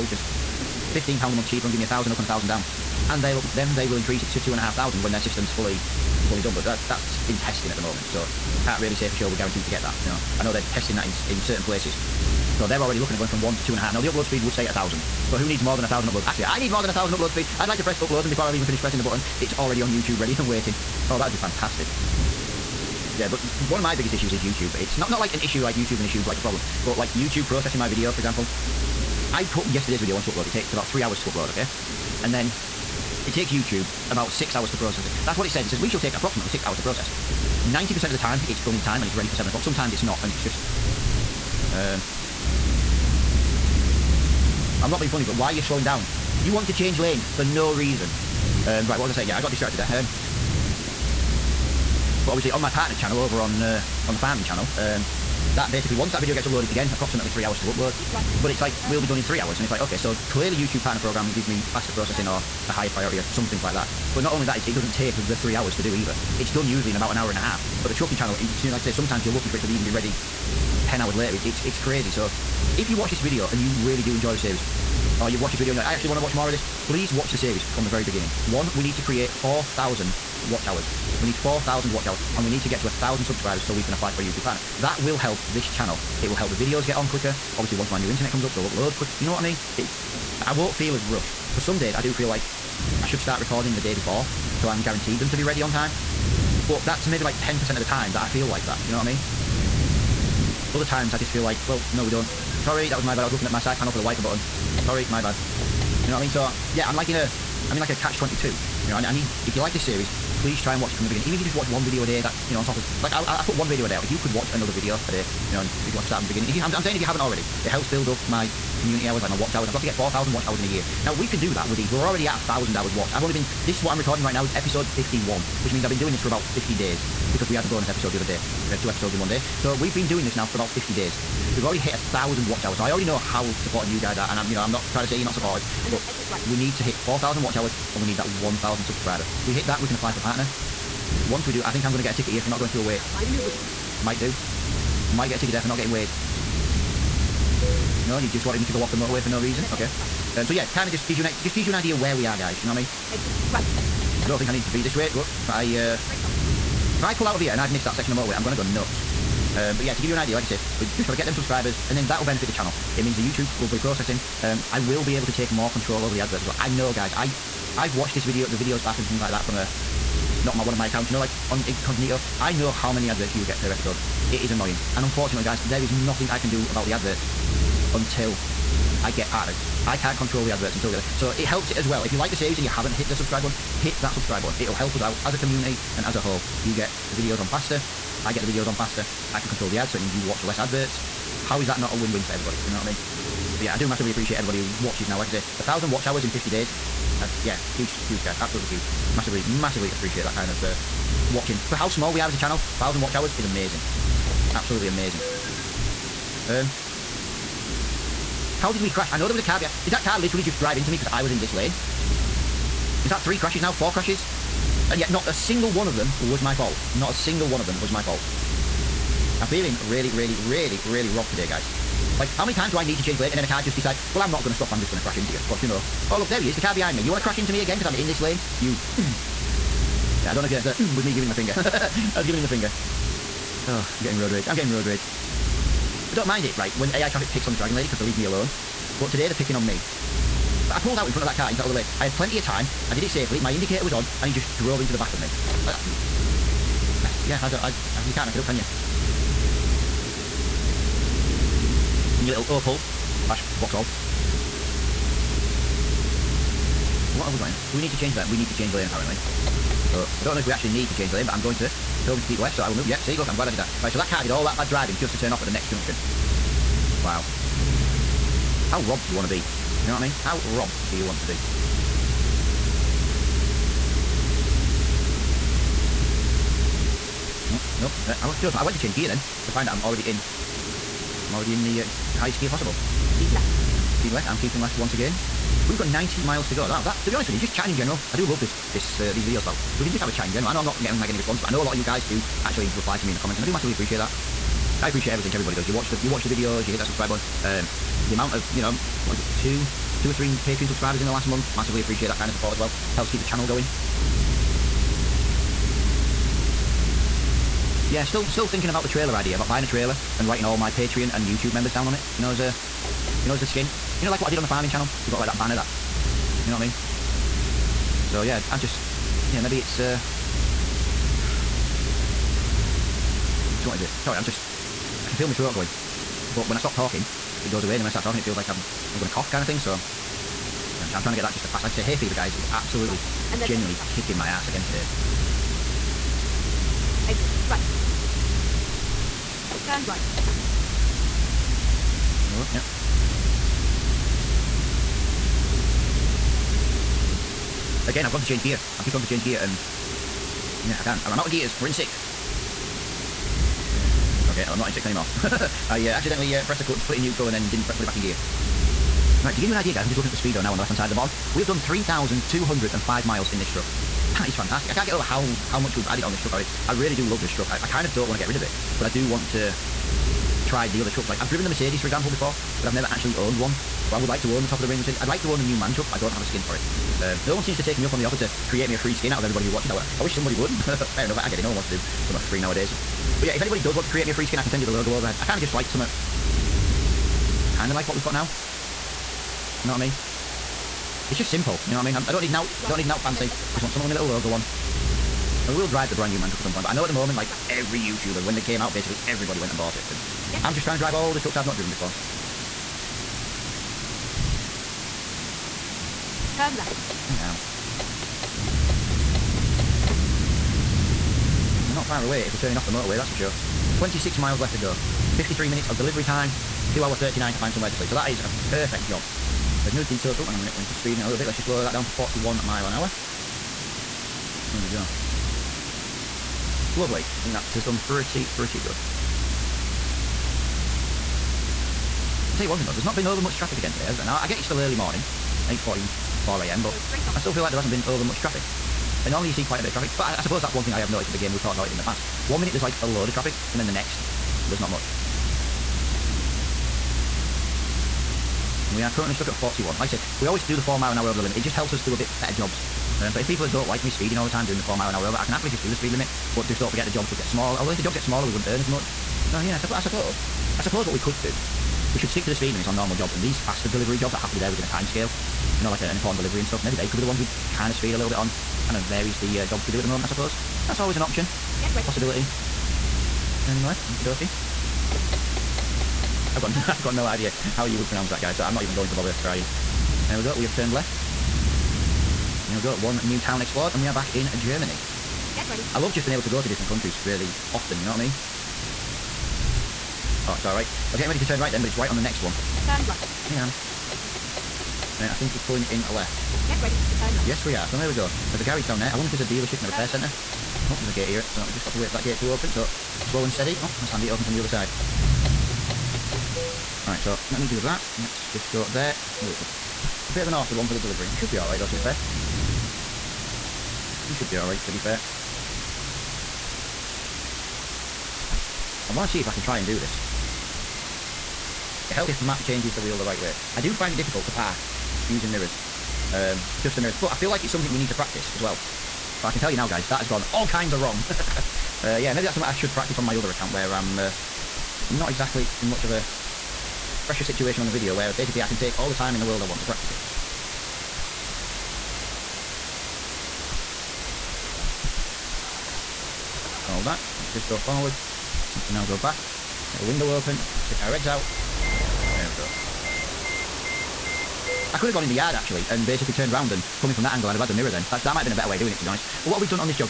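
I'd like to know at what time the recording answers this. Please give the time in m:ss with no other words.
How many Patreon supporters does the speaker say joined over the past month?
5:00.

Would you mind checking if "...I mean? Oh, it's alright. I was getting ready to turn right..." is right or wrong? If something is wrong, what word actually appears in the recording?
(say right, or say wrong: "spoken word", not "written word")
right.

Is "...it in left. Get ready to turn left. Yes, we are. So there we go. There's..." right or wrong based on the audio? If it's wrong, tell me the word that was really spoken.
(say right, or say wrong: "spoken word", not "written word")
right.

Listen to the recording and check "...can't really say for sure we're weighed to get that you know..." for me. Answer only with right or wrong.
wrong.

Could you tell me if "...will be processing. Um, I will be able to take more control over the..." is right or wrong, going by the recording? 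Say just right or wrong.
right.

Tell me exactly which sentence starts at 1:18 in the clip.
One, we need to create 4,000 watch hours.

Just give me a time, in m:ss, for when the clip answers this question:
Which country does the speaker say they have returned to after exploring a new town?
8:04.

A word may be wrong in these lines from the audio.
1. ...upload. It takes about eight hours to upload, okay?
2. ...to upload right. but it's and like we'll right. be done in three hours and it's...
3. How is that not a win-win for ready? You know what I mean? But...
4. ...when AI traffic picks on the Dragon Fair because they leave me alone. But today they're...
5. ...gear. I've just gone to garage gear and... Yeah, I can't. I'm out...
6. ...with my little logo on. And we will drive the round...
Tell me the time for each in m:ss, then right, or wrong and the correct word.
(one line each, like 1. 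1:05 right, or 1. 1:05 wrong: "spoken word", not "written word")
1. 0:30 wrong: "three", not "eight"
2. 0:57 right
3. 3:11 wrong: "everybody", not "ready"
4. 3:56 wrong: "Lady", not "Fair"
5. 5:48 wrong: "change", not "garage"
6. 6:33 wrong: "brand", not "round".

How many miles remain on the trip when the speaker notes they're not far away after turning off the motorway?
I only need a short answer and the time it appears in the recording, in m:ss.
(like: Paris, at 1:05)
26 miles, at 6:53.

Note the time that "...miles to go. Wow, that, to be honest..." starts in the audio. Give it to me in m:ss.
4:46.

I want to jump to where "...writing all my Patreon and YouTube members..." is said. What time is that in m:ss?
5:10.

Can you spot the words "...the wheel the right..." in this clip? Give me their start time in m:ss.
8:42.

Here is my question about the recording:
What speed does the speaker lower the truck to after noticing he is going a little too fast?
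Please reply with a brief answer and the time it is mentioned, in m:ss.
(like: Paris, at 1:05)
41 mph, at 7:01.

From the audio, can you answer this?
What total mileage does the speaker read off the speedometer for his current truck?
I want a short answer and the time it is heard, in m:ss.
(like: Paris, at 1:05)
3,205 miles, at 6:01.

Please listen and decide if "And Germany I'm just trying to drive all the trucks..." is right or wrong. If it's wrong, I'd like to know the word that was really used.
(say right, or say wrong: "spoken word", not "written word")
wrong: "Get", not "Germany".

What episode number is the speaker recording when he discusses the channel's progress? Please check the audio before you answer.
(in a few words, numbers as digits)
51.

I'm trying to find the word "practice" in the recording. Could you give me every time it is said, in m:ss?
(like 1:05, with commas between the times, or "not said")
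8:47, 8:52, 8:59.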